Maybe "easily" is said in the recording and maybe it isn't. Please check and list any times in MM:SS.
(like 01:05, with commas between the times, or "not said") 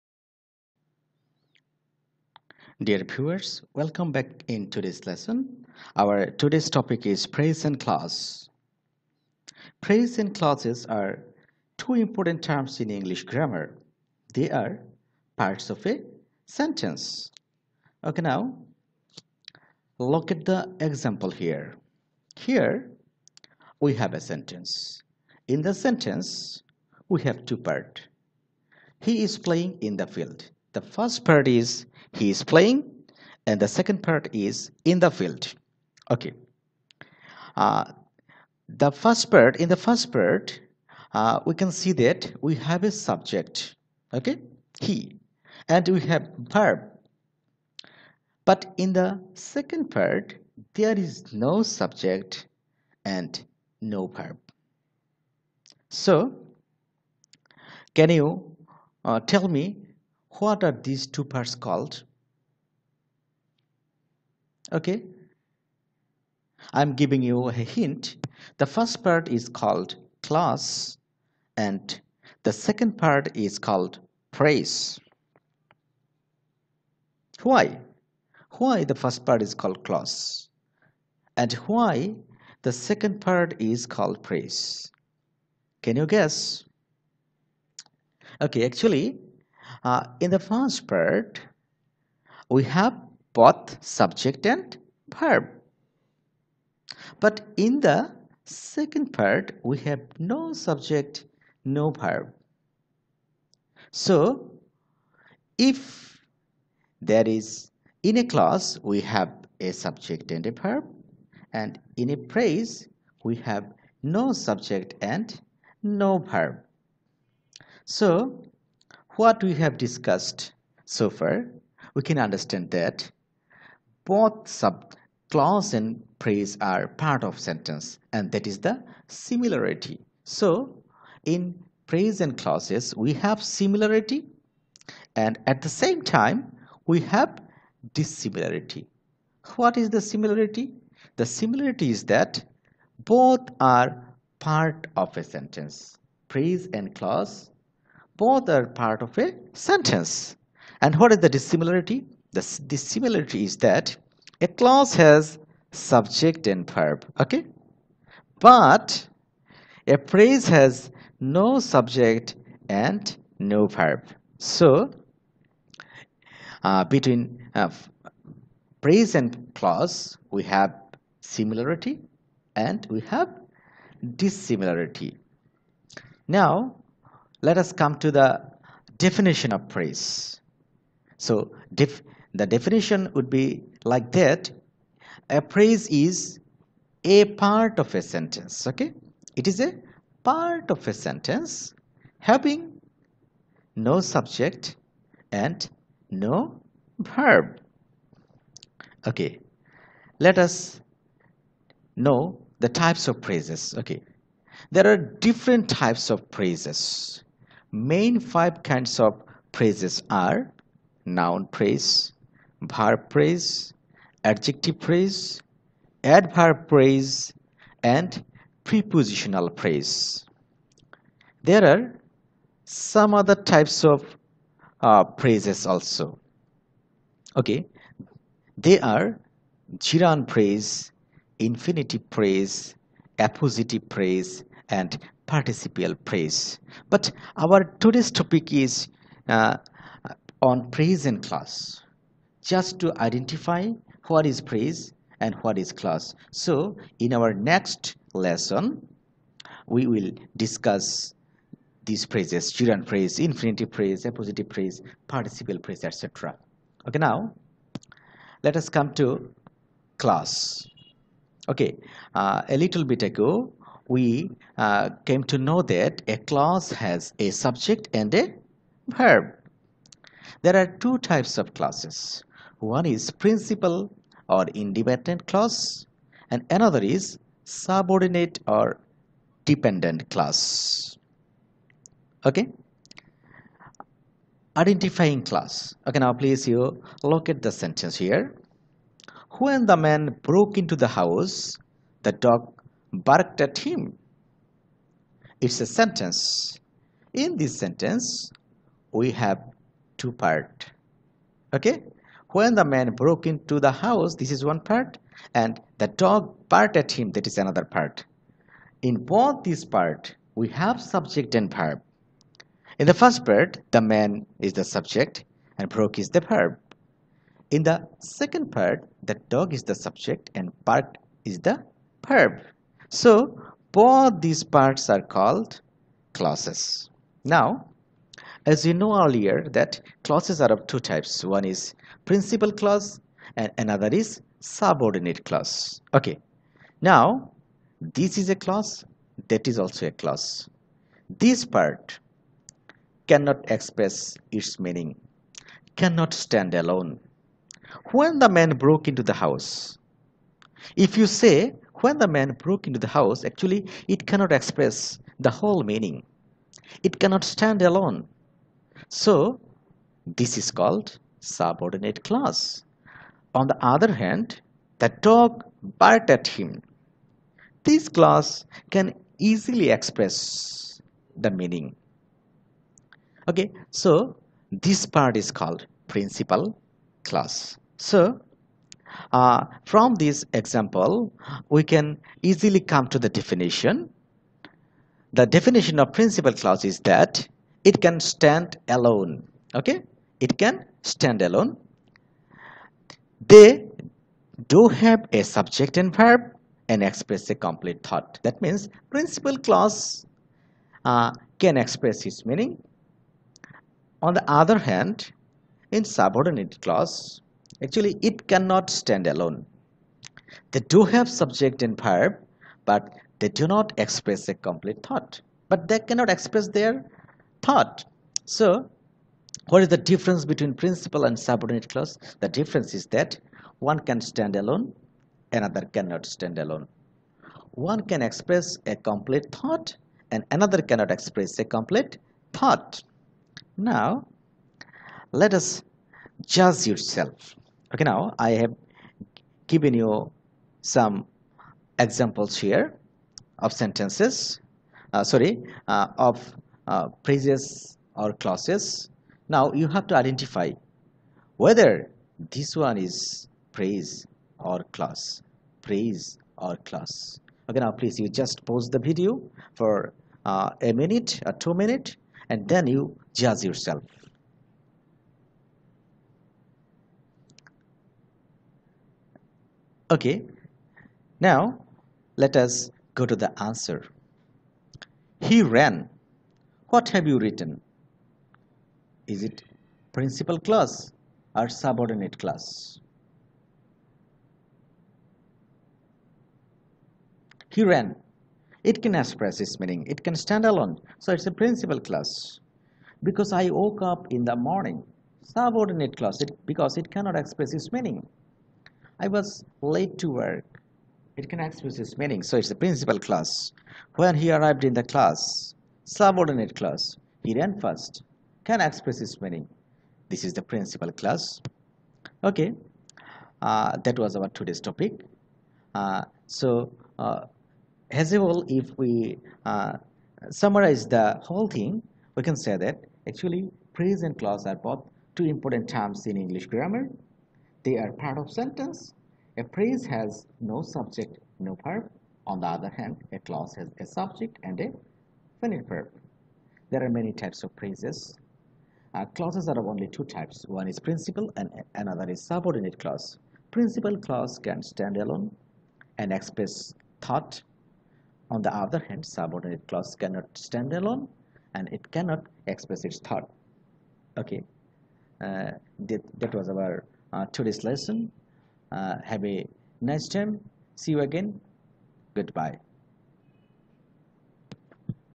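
06:09, 06:22.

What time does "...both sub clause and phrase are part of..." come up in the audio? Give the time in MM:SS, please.
02:04.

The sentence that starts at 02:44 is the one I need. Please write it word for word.
So, uh, between uh, phrase and clause, we have similarity and we have dissimilarity.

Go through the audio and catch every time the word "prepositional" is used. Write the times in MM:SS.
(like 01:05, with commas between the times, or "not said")
03:38.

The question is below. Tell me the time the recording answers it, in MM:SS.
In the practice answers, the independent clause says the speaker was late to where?
08:19.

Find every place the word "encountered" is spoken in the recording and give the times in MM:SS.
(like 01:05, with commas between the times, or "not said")
not said.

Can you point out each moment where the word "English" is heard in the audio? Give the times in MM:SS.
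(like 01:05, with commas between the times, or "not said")
00:12, 08:46.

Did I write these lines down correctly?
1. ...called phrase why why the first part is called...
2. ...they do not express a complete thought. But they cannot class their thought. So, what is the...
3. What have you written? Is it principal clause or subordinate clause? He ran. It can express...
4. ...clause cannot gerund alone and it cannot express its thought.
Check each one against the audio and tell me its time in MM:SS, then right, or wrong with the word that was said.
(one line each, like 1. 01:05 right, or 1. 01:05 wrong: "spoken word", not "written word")
1. 01:13 right
2. 06:53 wrong: "express", not "class"
3. 07:56 right
4. 09:09 wrong: "stand", not "gerund".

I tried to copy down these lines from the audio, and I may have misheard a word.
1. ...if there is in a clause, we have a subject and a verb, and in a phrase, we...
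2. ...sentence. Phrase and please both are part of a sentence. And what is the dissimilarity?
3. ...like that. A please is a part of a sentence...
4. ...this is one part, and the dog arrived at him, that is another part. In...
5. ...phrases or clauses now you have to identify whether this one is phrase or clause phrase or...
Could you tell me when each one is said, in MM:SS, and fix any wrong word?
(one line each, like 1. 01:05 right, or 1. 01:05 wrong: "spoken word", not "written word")
1. 01:45 right
2. 02:25 wrong: "clause", not "please"
3. 03:03 wrong: "phrase", not "please"
4. 05:04 wrong: "barked", not "arrived"
5. 07:27 right.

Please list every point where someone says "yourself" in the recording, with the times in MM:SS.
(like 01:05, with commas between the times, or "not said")
07:16, 07:43.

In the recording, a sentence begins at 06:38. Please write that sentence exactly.
That means principal clause uh, can express its meaning.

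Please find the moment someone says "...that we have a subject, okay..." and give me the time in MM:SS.
00:41.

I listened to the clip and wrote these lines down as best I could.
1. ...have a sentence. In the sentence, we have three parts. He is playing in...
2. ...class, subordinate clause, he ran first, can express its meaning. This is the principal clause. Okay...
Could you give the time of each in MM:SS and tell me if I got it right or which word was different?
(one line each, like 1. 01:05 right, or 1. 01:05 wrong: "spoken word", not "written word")
1. 00:23 wrong: "two", not "three"
2. 08:24 right.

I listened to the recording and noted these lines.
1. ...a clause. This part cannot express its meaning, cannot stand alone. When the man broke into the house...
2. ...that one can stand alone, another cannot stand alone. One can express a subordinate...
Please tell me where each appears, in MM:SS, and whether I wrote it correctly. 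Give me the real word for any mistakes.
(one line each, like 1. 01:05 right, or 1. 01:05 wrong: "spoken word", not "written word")
1. 05:39 right
2. 07:02 wrong: "complete", not "subordinate".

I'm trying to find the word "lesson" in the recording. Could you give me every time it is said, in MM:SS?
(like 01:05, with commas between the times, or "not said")
00:05, 04:08, 09:17.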